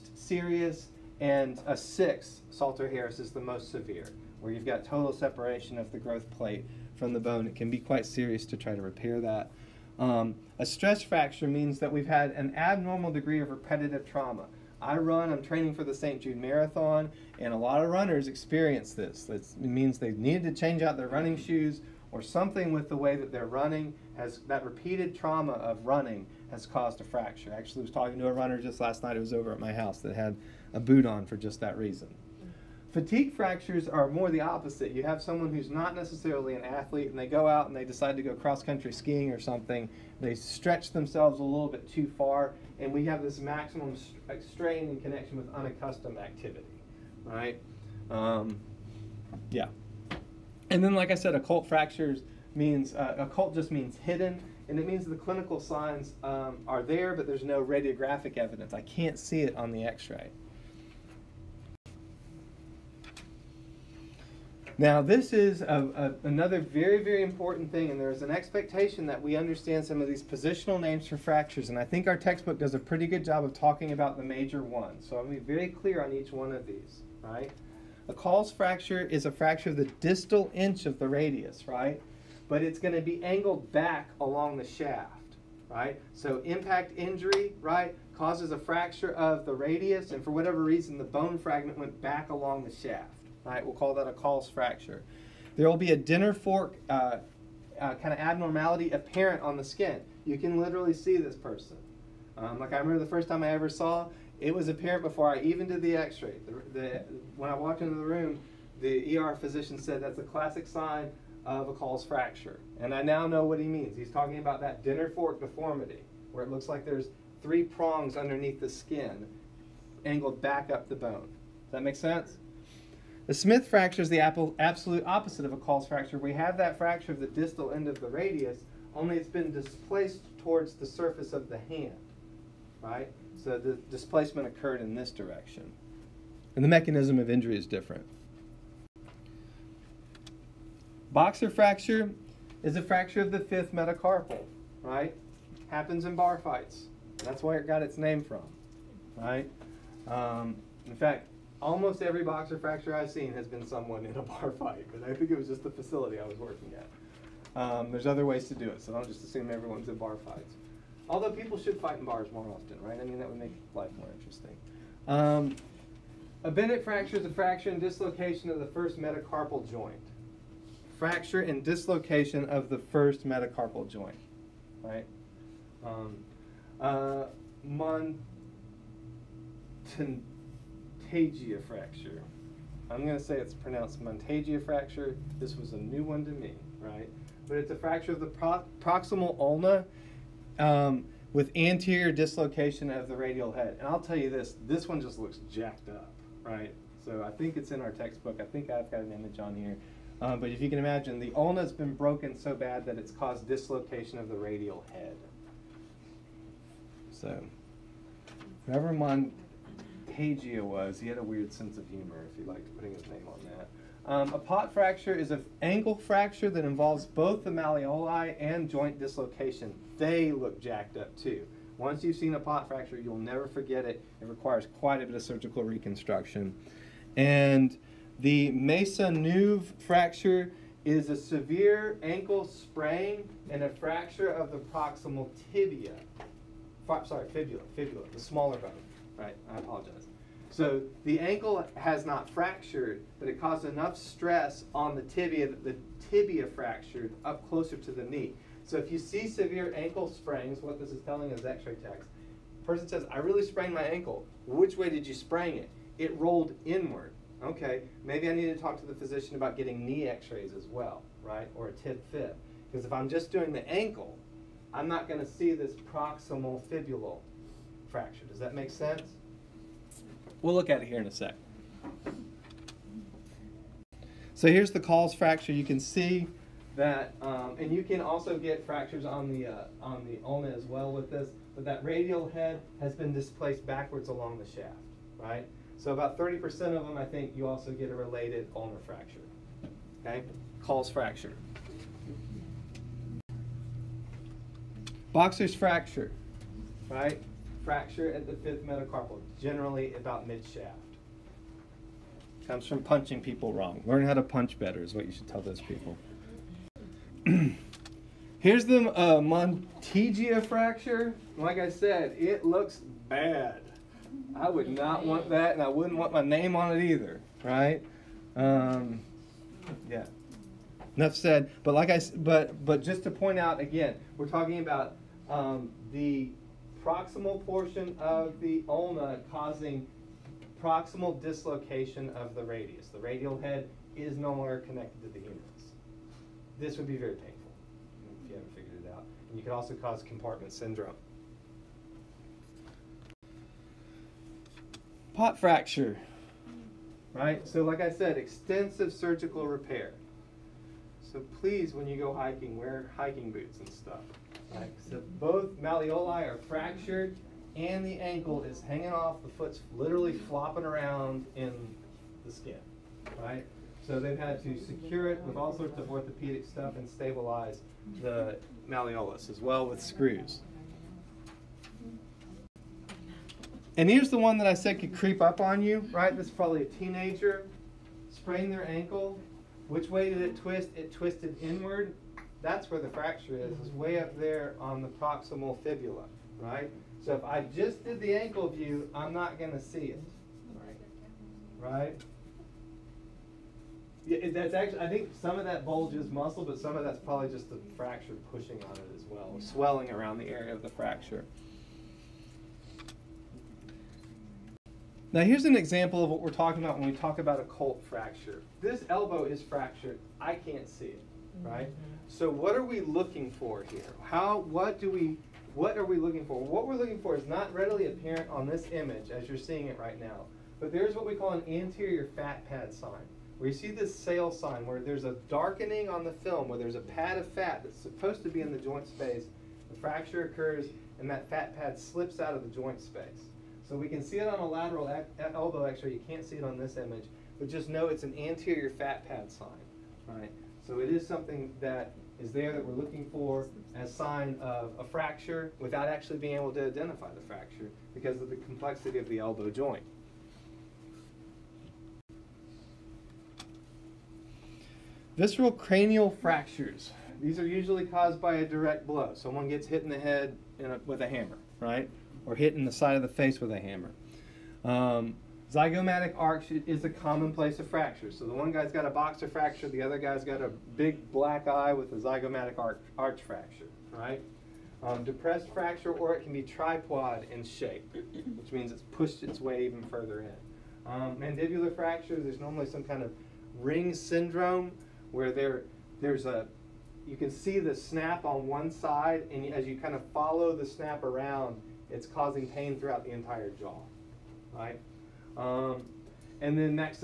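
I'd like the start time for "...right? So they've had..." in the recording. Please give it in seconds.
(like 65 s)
363 s.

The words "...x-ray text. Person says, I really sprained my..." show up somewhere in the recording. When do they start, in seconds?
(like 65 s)
251 s.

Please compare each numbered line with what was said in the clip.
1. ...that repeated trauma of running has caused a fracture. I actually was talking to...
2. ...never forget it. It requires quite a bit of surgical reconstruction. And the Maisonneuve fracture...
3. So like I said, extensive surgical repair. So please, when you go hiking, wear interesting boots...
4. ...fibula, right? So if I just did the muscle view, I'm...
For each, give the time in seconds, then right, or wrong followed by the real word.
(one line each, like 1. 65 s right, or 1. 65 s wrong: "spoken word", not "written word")
1. 24 s right
2. 223 s right
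3. 347 s wrong: "hiking", not "interesting"
4. 385 s wrong: "ankle", not "muscle".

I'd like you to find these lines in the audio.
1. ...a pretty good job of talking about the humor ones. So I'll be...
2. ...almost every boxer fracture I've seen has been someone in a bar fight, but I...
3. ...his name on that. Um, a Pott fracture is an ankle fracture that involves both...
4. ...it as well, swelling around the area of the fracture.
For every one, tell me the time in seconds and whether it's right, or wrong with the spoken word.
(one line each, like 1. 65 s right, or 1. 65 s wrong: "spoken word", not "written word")
1. 72 s wrong: "major", not "humor"
2. 151 s right
3. 212 s right
4. 398 s right.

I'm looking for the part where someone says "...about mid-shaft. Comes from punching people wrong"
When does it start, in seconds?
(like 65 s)
299 s.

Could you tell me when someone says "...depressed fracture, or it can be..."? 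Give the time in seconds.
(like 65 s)
475 s.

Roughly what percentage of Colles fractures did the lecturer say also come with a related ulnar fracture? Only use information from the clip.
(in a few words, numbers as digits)
30%.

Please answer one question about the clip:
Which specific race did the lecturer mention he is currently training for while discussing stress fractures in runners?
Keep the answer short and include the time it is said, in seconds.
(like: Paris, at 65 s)
St. Jude Marathon, at 15 s.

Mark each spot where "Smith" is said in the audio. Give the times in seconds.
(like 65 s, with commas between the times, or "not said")
123 s.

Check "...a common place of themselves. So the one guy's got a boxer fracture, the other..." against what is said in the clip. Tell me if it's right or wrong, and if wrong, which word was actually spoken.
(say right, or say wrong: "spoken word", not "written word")
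wrong: "fractures", not "themselves".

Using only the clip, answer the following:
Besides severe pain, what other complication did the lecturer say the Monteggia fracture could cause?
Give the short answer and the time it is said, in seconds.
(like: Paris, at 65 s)
compartment syndrome, at 340 s.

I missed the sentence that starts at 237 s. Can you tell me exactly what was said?
Sorry, fibula, fibula, the smaller bone right?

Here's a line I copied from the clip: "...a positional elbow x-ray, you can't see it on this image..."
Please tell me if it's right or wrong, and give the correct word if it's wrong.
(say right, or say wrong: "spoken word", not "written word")
wrong: "lateral", not "positional".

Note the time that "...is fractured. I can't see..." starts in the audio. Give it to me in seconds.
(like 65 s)
409 s.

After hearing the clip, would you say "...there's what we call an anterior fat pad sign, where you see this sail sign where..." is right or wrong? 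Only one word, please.
right.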